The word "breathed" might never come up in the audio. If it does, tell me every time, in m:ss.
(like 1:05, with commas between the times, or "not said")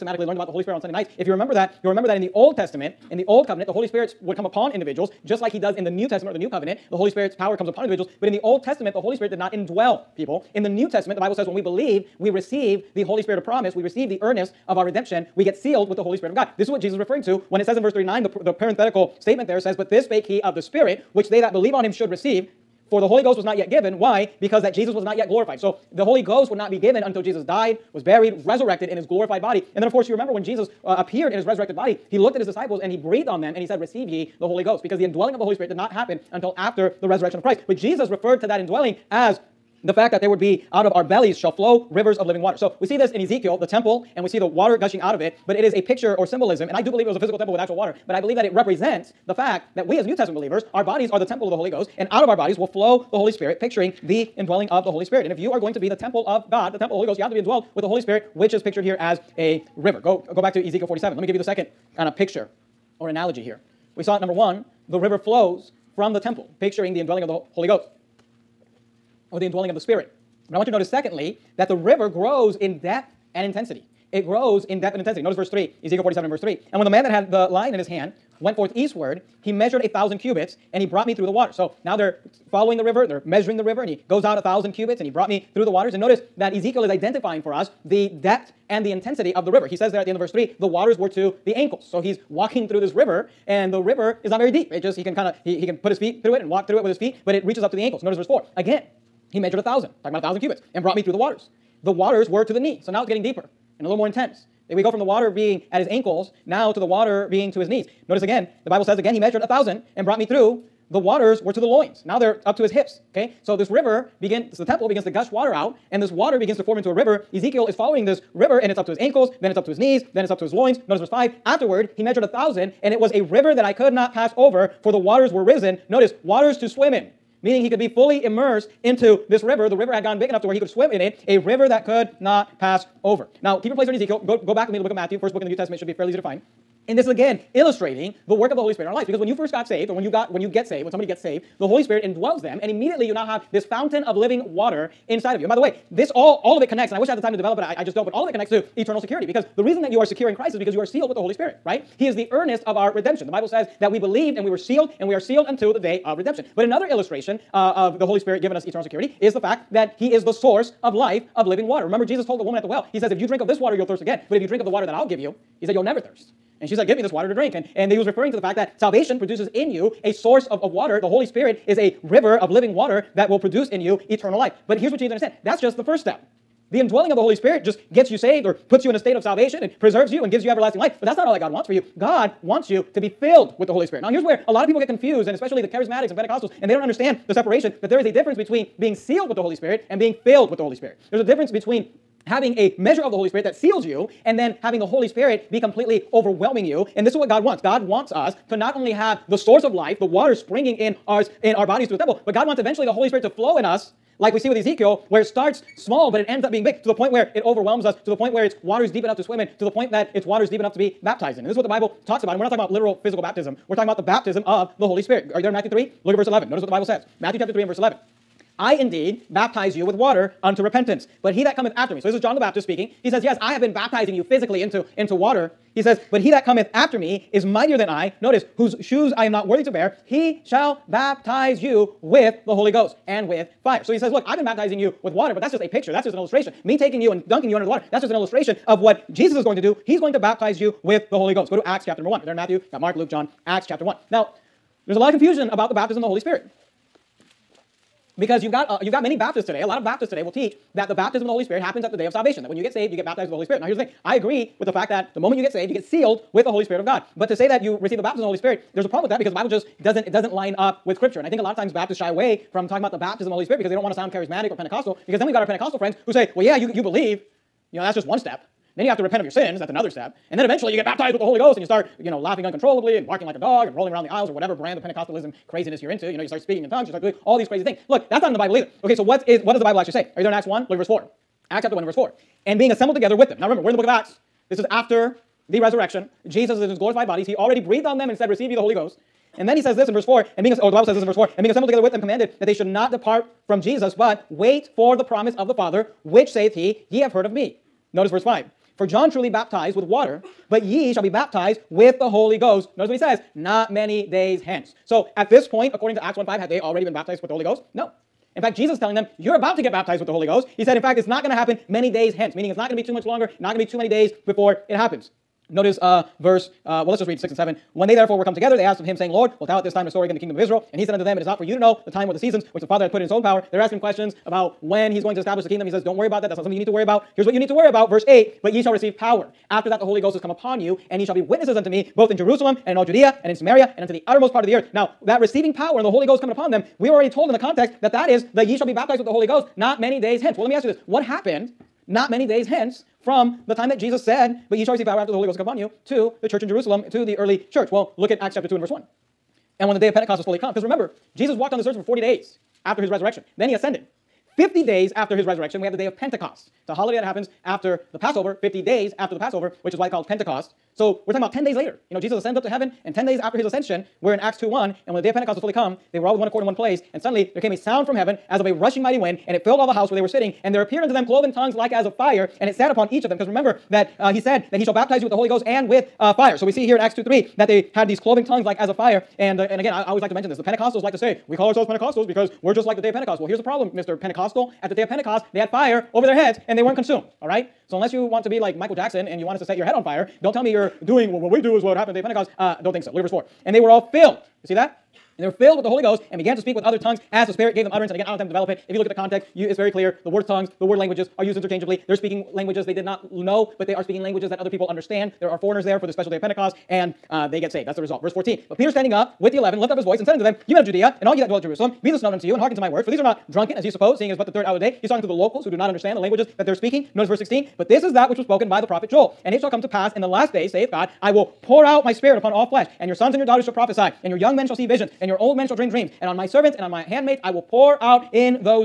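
0:32, 4:47.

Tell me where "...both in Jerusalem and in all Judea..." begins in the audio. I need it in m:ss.
5:31.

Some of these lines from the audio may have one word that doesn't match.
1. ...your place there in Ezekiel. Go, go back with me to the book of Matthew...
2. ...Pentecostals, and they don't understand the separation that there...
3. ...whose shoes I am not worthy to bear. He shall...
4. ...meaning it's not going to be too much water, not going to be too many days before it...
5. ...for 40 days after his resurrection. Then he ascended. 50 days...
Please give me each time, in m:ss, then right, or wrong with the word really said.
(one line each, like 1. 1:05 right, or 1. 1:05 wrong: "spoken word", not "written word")
1. 2:13 right
2. 3:06 right
3. 3:48 right
4. 5:12 wrong: "longer", not "water"
5. 5:51 right.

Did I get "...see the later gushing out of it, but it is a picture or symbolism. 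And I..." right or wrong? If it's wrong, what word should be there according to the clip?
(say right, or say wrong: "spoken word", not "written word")
wrong: "water", not "later".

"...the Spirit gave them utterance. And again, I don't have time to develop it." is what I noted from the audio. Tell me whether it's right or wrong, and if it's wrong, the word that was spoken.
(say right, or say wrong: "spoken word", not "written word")
right.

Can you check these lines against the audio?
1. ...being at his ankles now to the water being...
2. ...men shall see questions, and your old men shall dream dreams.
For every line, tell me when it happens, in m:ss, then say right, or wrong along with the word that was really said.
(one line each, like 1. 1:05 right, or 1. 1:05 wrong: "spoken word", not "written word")
1. 1:45 right
2. 7:04 wrong: "visions", not "questions".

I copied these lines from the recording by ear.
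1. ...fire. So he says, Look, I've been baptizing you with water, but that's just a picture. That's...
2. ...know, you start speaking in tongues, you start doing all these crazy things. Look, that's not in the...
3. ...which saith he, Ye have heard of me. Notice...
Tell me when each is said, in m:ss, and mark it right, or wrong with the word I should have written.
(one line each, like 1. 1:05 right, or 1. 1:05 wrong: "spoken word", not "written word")
1. 3:53 right
2. 4:36 right
3. 4:56 right.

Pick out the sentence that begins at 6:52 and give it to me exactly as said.
For these are not drunken, as ye suppose, seeing it is but the third hour of the day.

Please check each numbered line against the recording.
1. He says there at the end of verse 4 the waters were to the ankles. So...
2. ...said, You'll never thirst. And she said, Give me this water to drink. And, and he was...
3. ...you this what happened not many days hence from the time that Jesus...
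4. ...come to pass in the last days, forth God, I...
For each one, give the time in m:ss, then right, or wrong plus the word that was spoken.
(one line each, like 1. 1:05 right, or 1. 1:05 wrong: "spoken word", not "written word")
1. 1:29 wrong: "3", not "4"
2. 2:45 right
3. 5:40 right
4. 6:59 wrong: "saith", not "forth".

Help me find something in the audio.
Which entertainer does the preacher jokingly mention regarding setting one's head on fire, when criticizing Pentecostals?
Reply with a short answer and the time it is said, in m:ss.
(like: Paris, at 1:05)
Michael Jackson, at 6:28.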